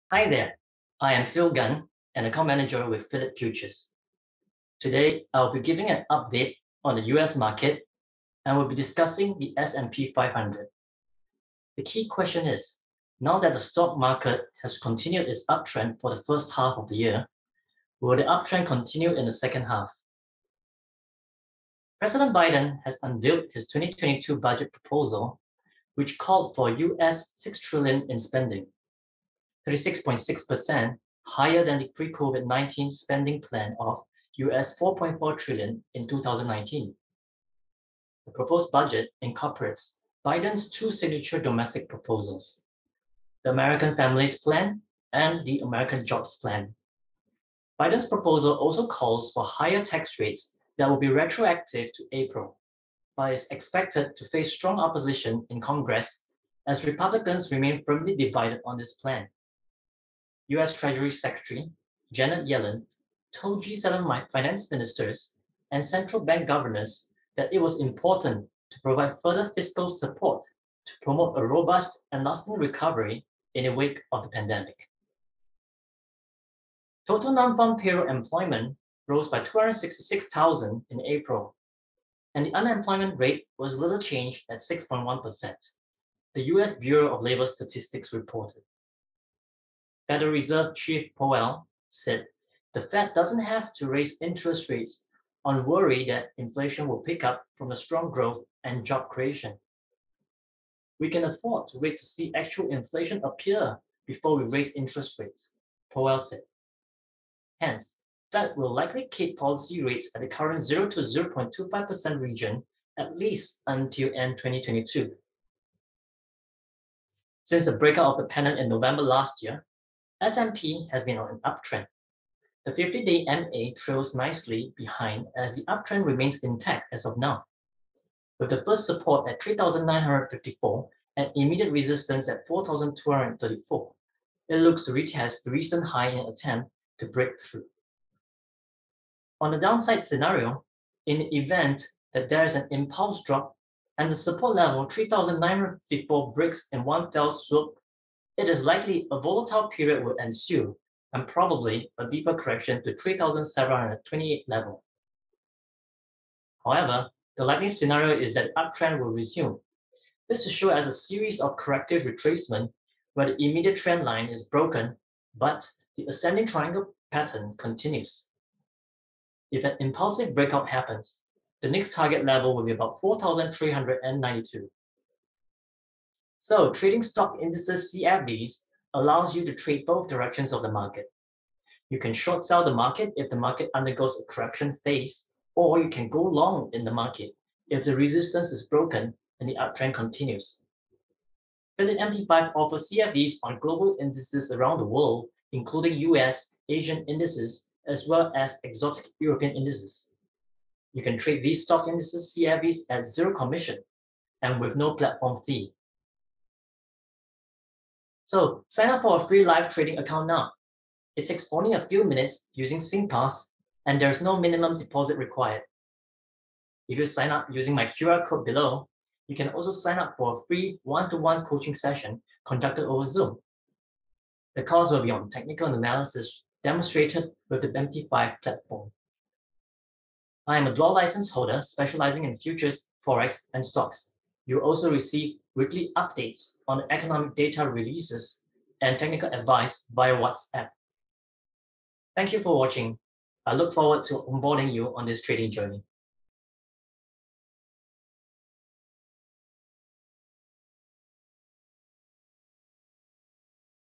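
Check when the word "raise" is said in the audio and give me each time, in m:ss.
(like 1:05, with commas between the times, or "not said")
1:33, 1:44.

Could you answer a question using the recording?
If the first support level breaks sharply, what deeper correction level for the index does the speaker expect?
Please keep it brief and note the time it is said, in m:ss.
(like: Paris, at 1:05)
3,728, at 2:32.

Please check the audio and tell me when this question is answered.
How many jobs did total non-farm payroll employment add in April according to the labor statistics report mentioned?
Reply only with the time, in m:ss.
1:19.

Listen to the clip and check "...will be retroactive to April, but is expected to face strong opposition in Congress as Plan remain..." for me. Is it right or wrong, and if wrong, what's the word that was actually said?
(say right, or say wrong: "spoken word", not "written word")
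wrong: "Republicans", not "Plan".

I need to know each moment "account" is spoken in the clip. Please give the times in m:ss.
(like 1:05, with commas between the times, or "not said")
0:02, 3:29.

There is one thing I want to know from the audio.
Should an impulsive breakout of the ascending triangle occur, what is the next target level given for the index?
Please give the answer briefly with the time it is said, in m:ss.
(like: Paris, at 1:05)
4,392, at 2:53.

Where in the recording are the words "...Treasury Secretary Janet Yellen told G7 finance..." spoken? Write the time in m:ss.
1:00.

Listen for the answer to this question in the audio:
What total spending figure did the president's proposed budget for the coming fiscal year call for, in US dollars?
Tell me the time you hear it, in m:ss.
0:27.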